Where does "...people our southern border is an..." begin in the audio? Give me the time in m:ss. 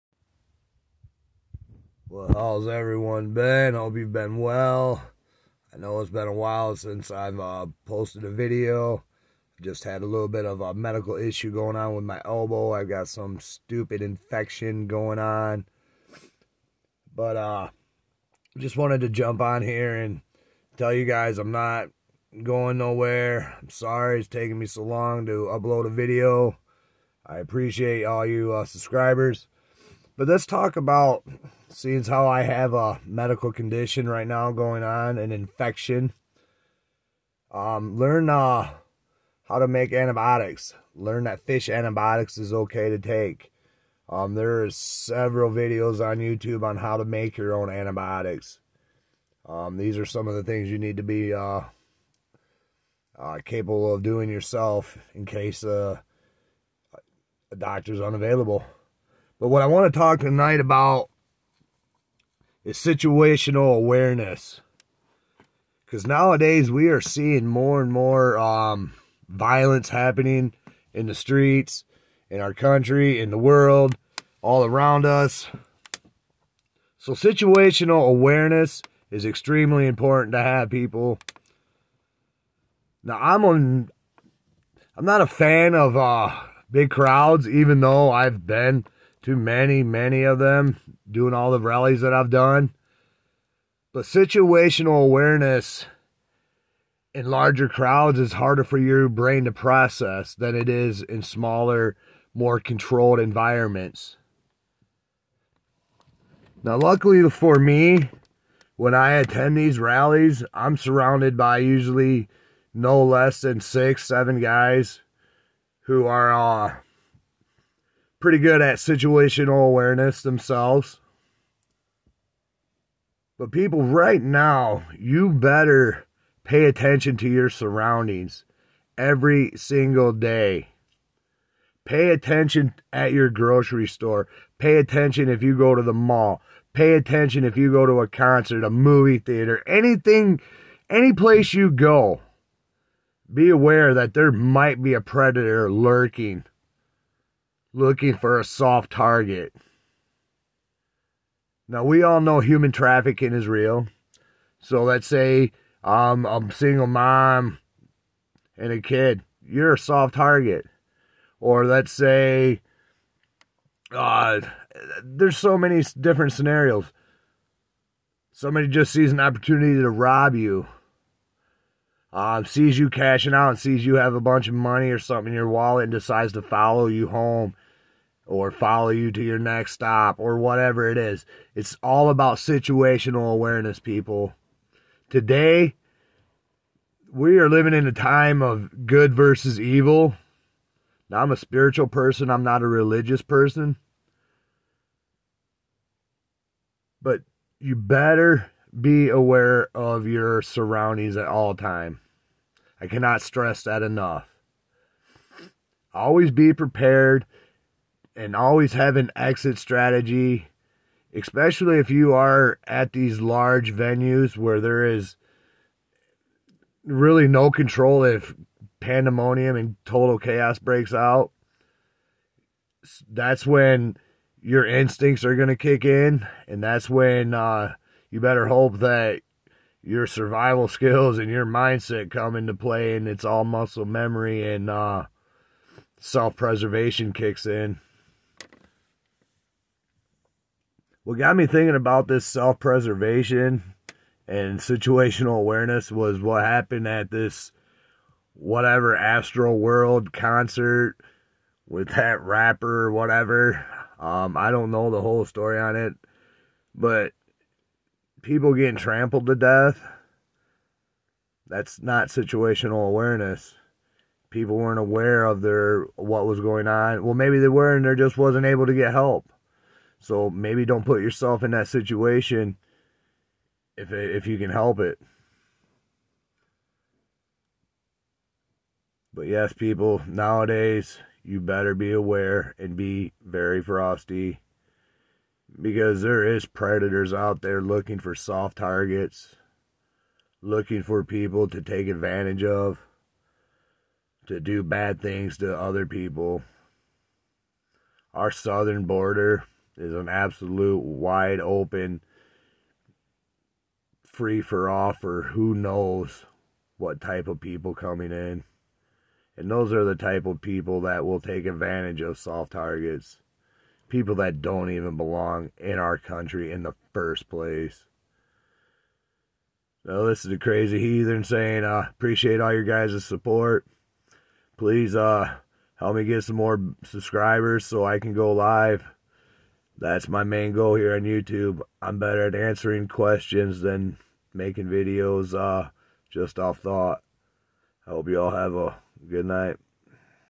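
4:55.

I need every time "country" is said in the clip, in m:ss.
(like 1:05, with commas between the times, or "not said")
1:12, 5:15.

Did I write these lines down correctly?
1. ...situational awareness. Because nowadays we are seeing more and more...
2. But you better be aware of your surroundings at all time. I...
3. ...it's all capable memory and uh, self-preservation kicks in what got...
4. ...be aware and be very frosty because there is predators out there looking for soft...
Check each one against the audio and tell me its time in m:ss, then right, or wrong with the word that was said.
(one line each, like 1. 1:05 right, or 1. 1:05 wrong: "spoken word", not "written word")
1. 1:02 right
2. 3:17 right
3. 3:53 wrong: "muscle", not "capable"
4. 4:41 right.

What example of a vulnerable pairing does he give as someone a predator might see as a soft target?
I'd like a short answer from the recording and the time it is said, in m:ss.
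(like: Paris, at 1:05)
A single mom and a kid, at 2:36.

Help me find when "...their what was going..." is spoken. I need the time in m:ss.
4:25.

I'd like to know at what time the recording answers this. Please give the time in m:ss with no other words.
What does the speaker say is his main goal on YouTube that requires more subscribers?
5:28.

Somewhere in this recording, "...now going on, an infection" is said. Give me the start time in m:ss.
0:34.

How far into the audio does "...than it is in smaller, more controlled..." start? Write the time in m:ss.
1:40.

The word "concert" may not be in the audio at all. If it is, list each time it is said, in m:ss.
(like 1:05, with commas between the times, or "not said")
2:18, 4:10.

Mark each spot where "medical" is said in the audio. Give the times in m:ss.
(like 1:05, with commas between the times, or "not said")
0:10, 0:33.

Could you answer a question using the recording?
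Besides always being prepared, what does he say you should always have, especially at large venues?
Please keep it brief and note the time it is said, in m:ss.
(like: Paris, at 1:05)
An exit strategy, at 3:28.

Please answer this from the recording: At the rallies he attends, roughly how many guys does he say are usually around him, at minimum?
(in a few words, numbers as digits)
6 or 7.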